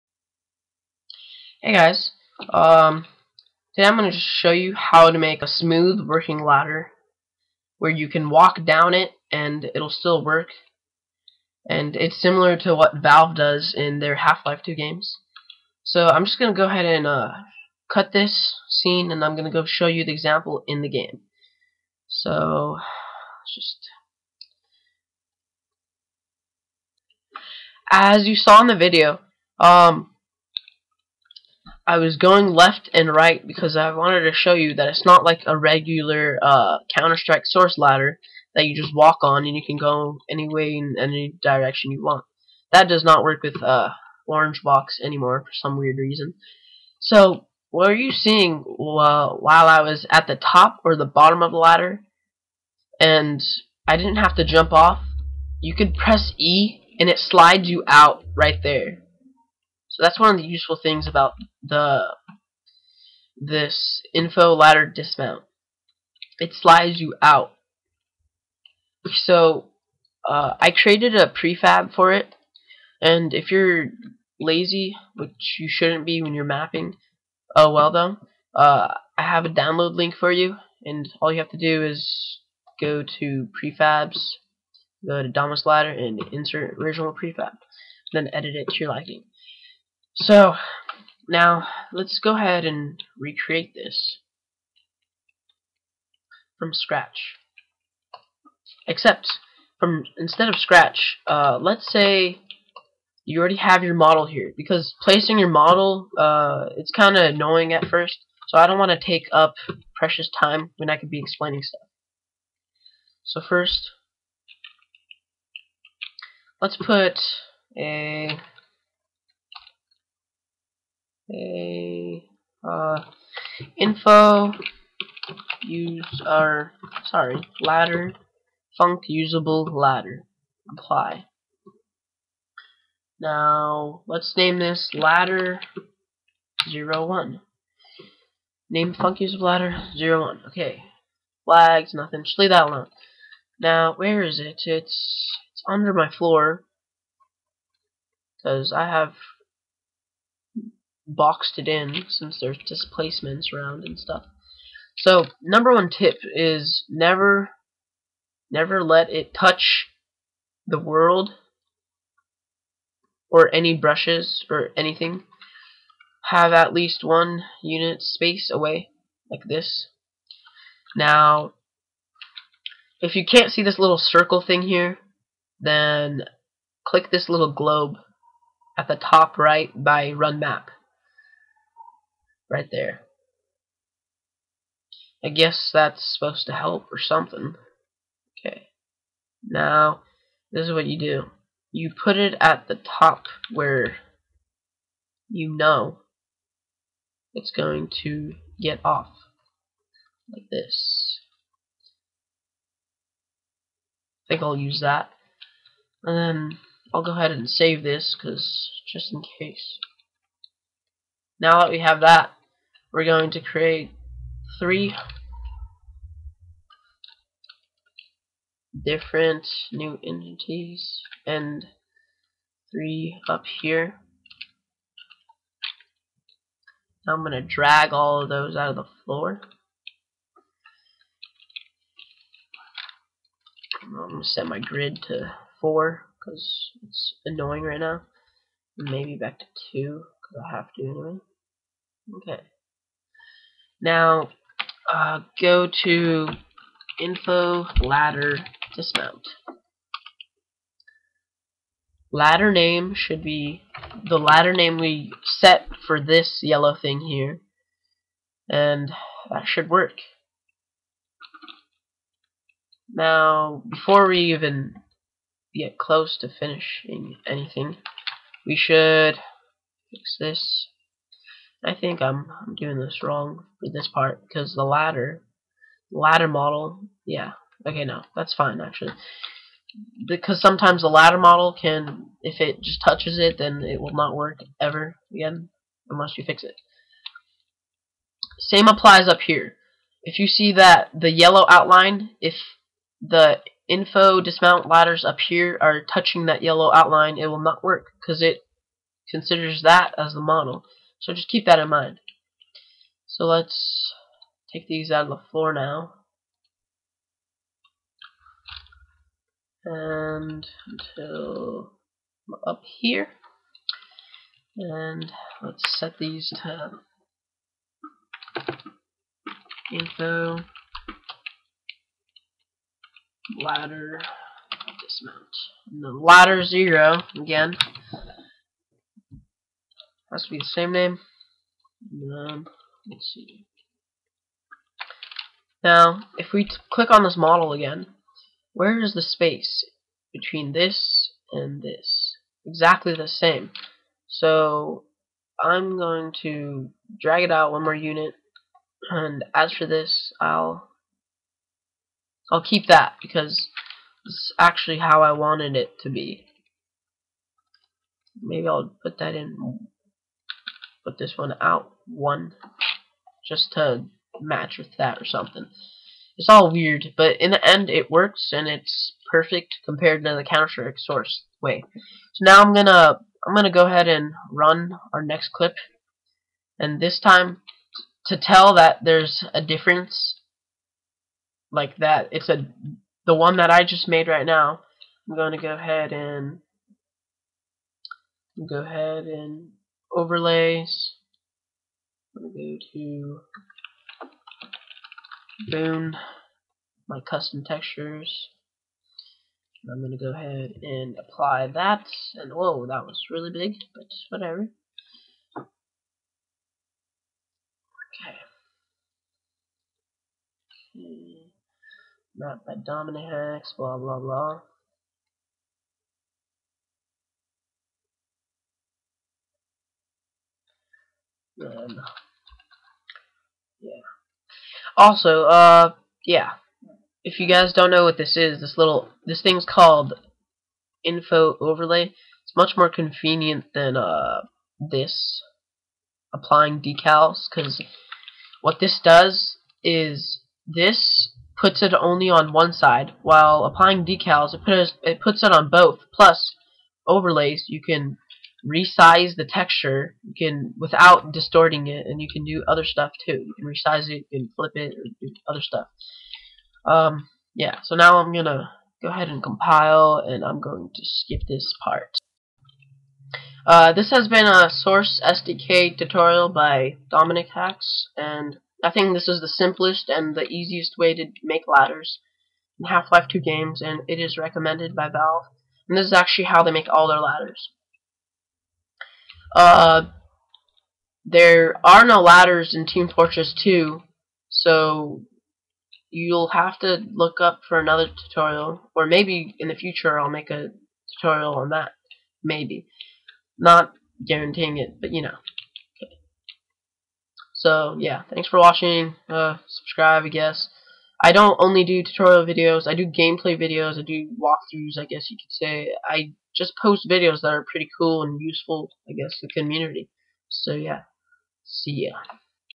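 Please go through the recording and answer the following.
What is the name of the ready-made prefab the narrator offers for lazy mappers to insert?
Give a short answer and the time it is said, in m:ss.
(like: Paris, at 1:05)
Domus ladder, at 1:25.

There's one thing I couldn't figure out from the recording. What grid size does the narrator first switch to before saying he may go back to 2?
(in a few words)
4.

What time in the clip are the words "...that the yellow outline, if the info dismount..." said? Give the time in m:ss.
4:50.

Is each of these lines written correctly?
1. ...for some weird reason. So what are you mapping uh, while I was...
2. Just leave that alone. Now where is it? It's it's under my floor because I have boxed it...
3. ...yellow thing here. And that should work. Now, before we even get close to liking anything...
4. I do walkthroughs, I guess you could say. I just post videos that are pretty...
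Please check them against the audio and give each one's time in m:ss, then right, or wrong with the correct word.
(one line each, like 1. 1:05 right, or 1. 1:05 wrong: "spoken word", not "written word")
1. 0:45 wrong: "seeing", not "mapping"
2. 2:22 right
3. 4:16 wrong: "finishing", not "liking"
4. 8:23 right.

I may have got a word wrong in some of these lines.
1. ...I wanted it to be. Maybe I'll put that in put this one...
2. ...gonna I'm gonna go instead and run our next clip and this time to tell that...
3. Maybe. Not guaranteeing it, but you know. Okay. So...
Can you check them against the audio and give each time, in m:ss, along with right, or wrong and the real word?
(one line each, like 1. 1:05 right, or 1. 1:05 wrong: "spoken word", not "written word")
1. 5:55 right
2. 6:12 wrong: "ahead", not "instead"
3. 8:12 right.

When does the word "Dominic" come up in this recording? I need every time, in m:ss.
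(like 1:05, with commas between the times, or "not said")
6:52, 7:46.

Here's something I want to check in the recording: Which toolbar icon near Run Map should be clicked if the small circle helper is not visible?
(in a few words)
little globe.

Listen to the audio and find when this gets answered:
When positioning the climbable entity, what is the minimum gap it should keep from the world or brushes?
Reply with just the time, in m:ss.
2:47.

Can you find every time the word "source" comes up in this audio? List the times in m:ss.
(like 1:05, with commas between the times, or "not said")
0:37, 6:10, 7:44.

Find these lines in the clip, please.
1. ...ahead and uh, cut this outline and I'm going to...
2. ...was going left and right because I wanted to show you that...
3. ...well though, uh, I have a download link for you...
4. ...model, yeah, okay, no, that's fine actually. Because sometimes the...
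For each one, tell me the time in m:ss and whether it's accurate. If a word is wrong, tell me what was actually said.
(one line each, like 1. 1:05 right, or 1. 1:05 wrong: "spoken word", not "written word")
1. 0:16 wrong: "scene", not "outline"
2. 0:31 right
3. 1:17 right
4. 4:36 right.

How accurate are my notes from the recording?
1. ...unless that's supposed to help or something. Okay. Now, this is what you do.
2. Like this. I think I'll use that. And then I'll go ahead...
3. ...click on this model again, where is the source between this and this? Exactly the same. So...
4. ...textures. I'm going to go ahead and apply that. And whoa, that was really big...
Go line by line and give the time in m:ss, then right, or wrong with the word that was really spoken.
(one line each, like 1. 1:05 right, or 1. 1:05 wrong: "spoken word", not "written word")
1. 3:05 wrong: "guess", not "unless"
2. 3:20 right
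3. 5:36 wrong: "space", not "source"
4. 6:37 right.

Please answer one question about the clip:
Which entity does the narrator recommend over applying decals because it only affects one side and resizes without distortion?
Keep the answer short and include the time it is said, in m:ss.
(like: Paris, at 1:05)
info overlay, at 7:10.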